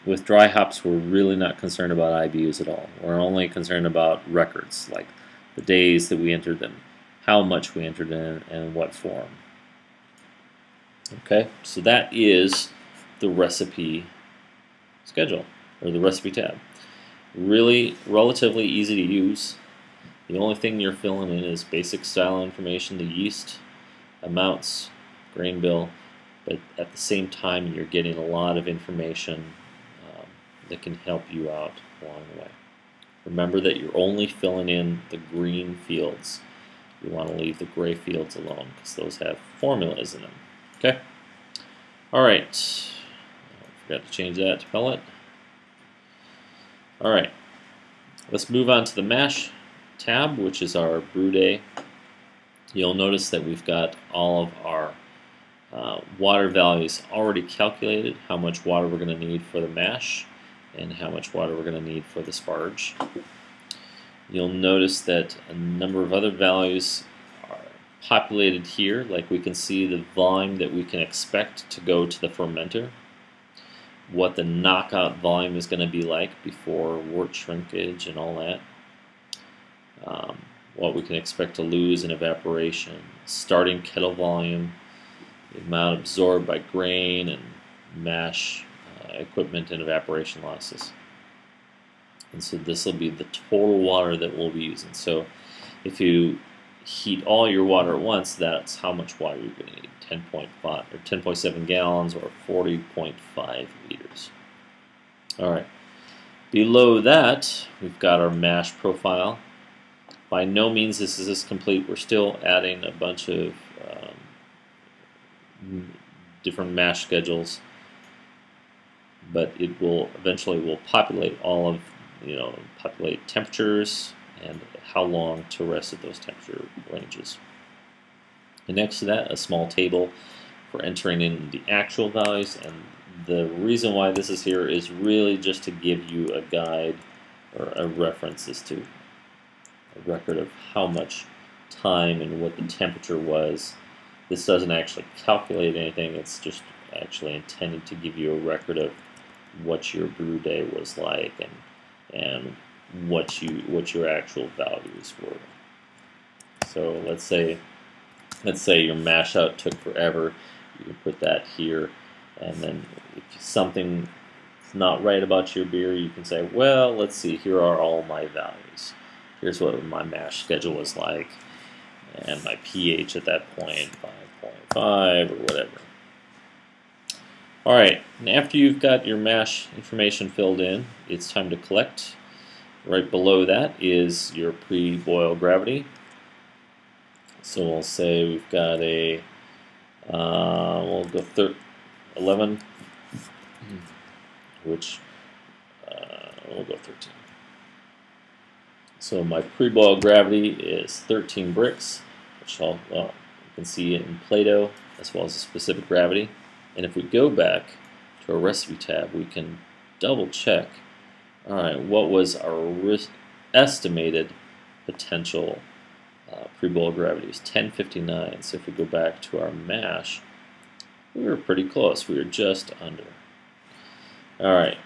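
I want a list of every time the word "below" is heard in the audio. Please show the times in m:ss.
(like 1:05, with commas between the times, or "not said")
1:46, 3:03.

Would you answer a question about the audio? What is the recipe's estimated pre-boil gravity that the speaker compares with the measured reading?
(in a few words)
1059.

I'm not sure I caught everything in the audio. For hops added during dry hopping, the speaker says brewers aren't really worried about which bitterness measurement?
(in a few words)
IBUs.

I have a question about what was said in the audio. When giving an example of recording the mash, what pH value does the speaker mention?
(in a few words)
5.5.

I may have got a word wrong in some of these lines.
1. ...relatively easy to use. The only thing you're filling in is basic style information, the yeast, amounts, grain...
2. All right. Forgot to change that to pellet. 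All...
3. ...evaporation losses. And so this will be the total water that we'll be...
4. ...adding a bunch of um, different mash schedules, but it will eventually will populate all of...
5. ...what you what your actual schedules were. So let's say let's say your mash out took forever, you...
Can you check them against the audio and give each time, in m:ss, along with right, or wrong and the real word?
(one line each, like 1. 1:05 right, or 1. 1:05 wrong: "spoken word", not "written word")
1. 0:18 right
2. 0:42 right
3. 1:29 right
4. 1:52 right
5. 2:33 wrong: "values", not "schedules".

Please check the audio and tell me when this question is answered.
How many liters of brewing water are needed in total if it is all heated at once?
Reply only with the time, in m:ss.
1:42.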